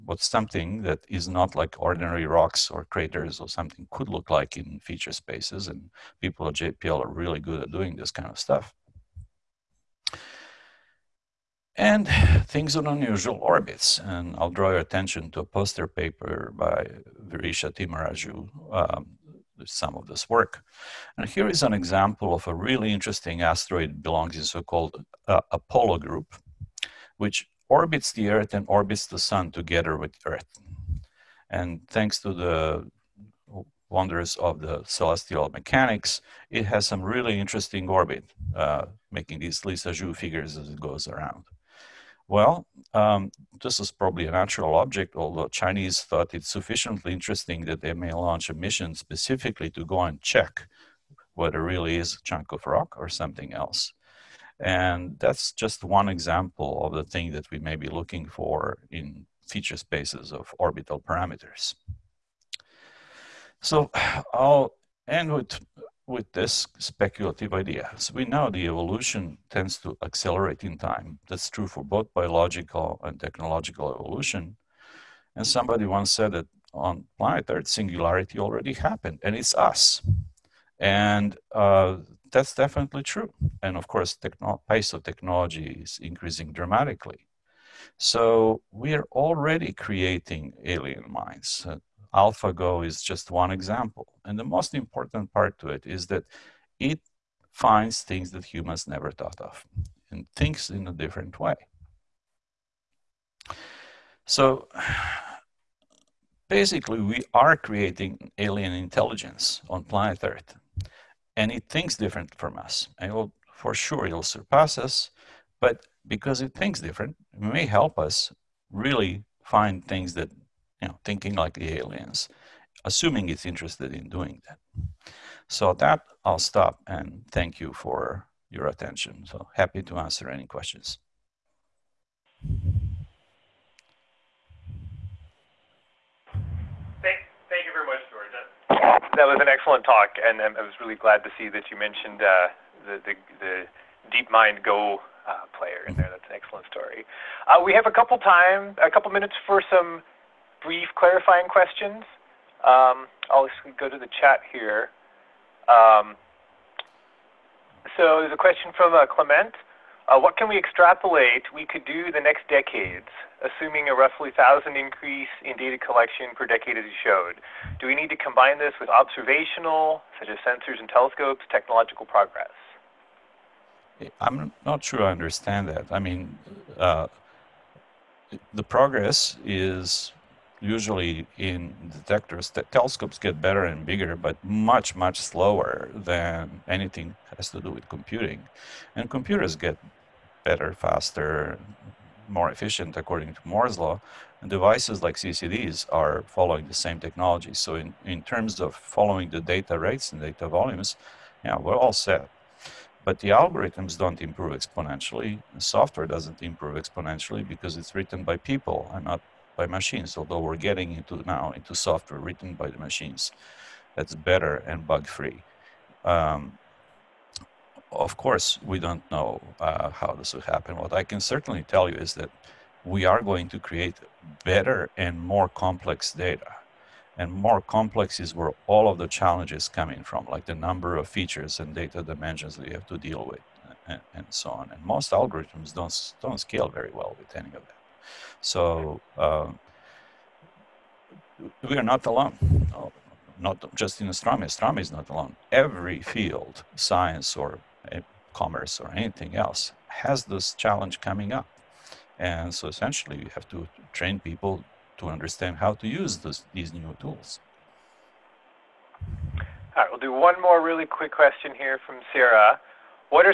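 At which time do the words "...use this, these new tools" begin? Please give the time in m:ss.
4:15.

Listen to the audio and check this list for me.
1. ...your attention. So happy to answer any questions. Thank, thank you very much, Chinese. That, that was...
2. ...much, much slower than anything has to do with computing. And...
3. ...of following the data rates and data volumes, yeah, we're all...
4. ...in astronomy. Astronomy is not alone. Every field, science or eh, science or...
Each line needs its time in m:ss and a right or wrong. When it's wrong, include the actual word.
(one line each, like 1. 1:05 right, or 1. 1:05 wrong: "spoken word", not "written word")
1. 2:08 wrong: "George", not "Chinese"
2. 3:04 right
3. 3:18 right
4. 4:04 wrong: "commerce", not "science".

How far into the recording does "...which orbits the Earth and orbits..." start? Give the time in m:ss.
0:27.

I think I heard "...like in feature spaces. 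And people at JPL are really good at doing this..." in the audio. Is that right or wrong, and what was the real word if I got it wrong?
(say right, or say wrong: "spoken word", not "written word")
right.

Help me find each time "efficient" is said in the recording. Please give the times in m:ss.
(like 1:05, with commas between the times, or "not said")
3:12.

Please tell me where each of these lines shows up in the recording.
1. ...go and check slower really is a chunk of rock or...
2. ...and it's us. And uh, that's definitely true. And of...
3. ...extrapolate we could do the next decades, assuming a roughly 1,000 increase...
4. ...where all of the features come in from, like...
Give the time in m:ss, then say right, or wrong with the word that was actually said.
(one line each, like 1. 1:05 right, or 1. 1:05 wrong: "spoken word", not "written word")
1. 0:49 wrong: "whether", not "slower"
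2. 1:19 right
3. 2:40 right
4. 3:48 wrong: "challenges", not "features".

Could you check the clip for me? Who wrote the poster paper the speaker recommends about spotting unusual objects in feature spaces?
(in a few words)
Virisha Timaraju.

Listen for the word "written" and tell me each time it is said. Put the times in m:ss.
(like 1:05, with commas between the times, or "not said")
3:27, 3:32.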